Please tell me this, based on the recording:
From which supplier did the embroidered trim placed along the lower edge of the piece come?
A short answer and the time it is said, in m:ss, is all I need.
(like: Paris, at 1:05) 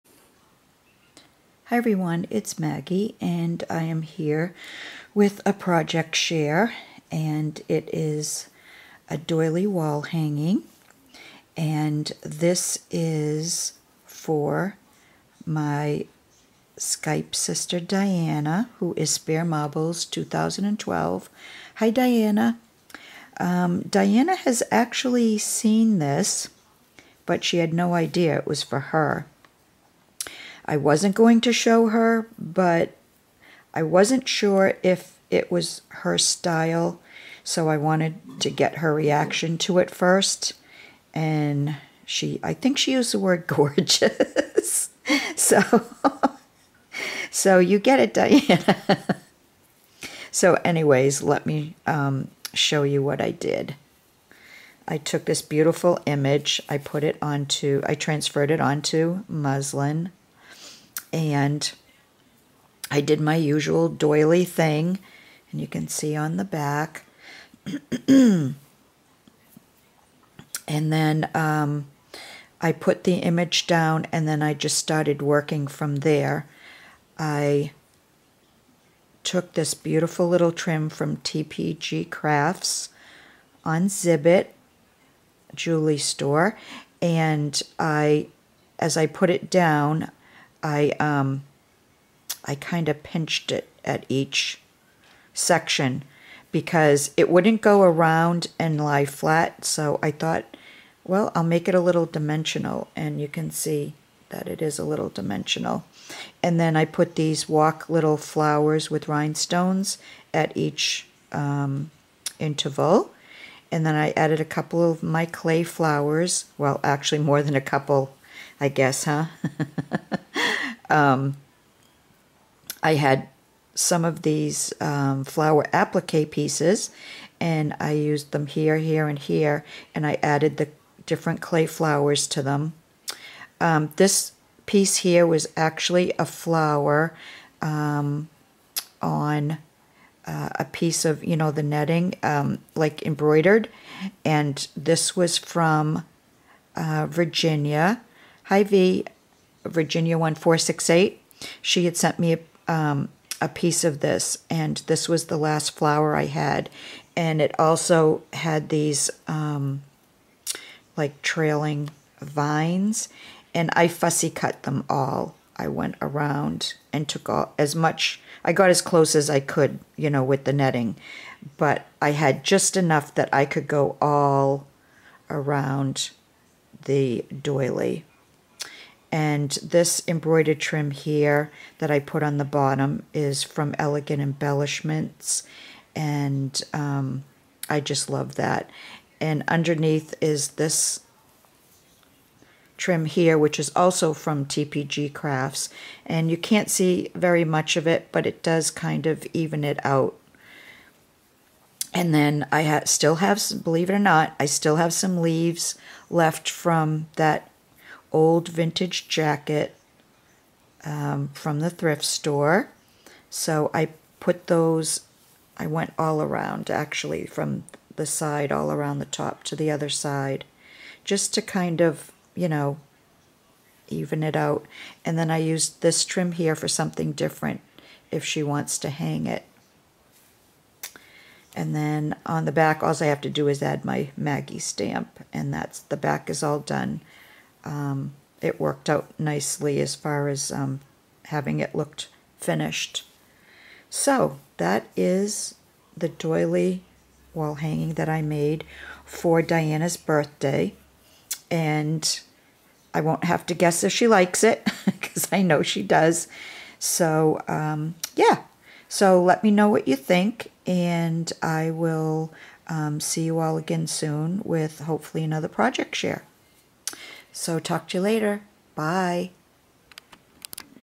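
Elegant Embellishments, at 3:03.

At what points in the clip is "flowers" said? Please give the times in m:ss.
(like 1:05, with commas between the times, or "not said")
1:48, 1:55, 2:05, 2:11, 2:16, 2:35.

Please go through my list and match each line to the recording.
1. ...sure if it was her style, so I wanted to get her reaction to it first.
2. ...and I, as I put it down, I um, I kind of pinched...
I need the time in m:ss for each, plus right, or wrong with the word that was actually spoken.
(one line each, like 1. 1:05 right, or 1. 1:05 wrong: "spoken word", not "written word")
1. 0:34 right
2. 1:27 right.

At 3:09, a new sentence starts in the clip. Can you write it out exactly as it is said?
And underneath is this trim here, which is also from TPG Crafts.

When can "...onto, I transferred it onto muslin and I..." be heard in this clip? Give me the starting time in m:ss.
0:57.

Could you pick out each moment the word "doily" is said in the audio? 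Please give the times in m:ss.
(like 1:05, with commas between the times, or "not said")
0:09, 1:03, 2:57, 4:06.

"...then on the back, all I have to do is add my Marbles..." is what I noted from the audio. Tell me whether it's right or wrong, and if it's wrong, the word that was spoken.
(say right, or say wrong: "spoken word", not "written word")
wrong: "Maggie", not "Marbles".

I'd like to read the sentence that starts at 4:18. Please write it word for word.
So let me know what you think, and I will um, see you all again soon with hopefully another project share.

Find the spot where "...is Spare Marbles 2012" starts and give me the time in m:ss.
0:18.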